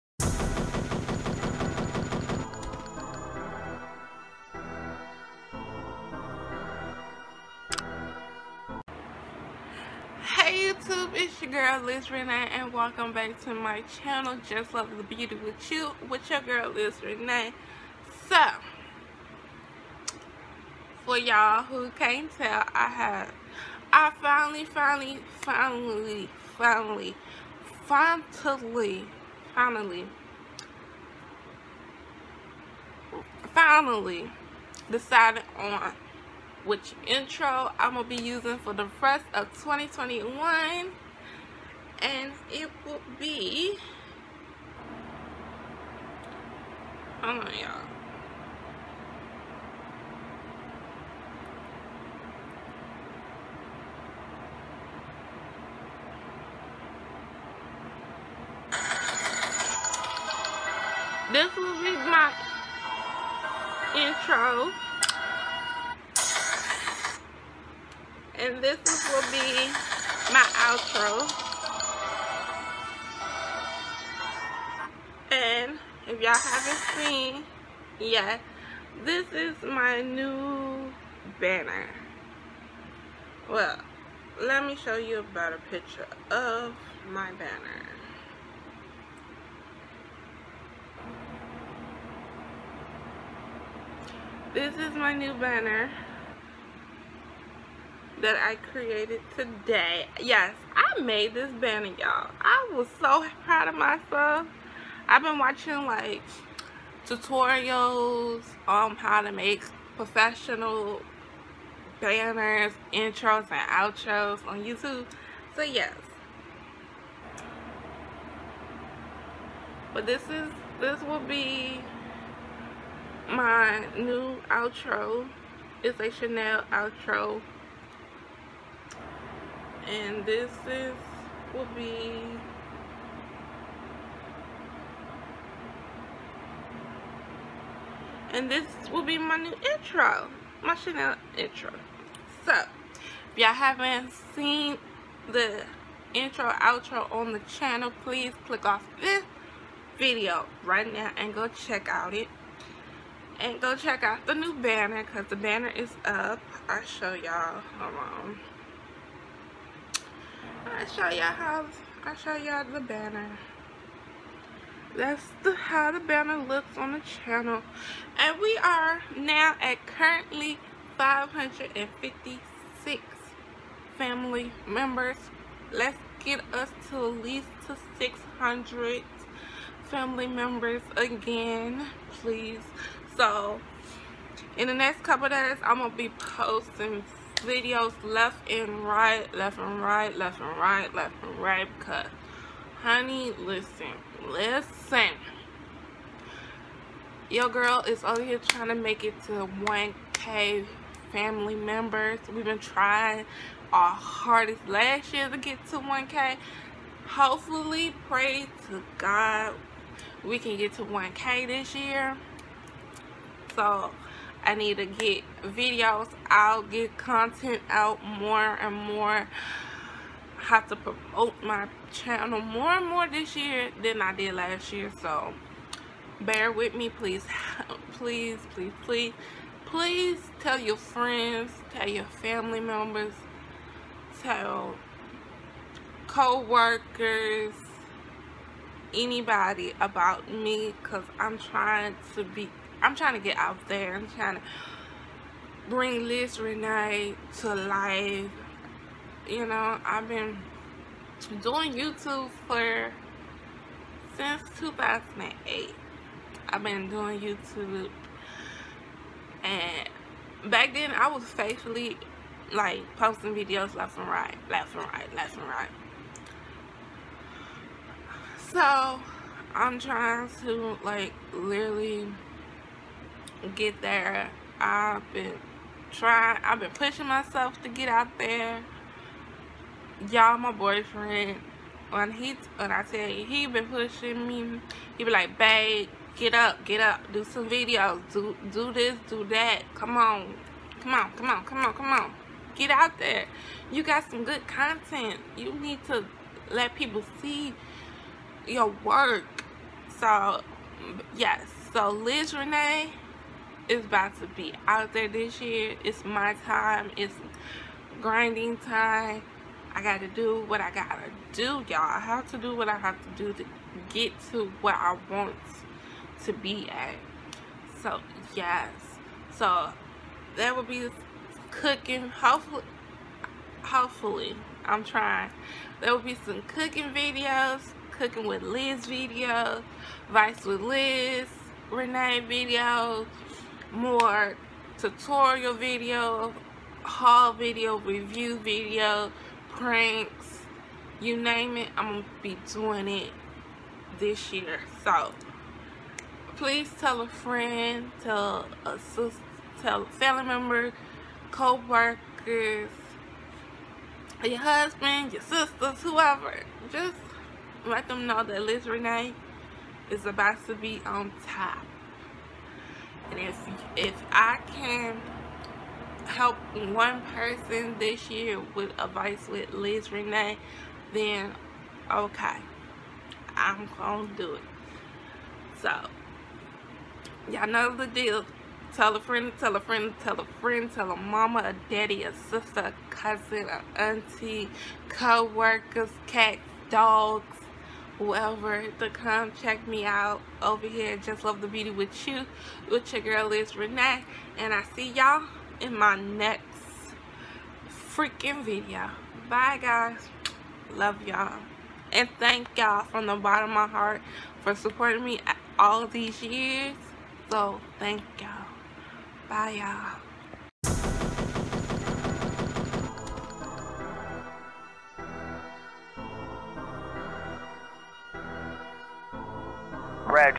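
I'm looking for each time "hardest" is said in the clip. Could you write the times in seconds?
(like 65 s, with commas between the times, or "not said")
203 s.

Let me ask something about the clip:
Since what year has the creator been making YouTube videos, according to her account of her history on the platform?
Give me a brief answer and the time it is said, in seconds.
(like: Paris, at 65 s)
2008, at 254 s.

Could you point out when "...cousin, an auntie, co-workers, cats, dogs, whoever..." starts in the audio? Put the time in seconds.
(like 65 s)
382 s.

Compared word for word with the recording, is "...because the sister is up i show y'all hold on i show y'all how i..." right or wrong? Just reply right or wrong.
wrong.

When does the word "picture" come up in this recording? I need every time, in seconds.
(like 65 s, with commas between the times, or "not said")
85 s.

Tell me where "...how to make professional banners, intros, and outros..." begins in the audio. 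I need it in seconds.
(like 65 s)
108 s.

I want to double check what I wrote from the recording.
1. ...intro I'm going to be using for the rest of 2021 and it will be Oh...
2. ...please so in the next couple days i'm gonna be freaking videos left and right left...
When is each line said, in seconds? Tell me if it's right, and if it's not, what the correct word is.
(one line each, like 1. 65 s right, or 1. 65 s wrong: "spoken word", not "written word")
1. 37 s right
2. 182 s wrong: "posting", not "freaking".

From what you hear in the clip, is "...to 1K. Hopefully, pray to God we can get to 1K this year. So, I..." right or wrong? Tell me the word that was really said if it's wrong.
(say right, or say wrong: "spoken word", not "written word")
right.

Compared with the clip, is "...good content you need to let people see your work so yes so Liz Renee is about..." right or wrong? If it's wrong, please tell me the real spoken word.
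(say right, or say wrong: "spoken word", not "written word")
right.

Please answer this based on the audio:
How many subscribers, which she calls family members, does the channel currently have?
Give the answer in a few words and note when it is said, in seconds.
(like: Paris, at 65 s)
556, at 170 s.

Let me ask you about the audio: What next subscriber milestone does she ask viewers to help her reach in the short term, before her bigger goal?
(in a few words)
600.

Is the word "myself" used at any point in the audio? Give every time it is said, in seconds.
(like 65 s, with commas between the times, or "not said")
103 s, 277 s.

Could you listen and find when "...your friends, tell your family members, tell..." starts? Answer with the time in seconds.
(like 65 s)
230 s.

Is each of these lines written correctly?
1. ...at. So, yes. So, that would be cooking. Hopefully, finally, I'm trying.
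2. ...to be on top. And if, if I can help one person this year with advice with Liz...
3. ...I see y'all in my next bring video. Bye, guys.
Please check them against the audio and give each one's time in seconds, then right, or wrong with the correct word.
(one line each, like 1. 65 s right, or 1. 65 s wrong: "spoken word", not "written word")
1. 316 s wrong: "hopefully", not "finally"
2. 360 s right
3. 394 s wrong: "freaking", not "bring".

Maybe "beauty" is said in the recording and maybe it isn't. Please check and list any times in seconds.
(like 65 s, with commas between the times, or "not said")
15 s, 391 s.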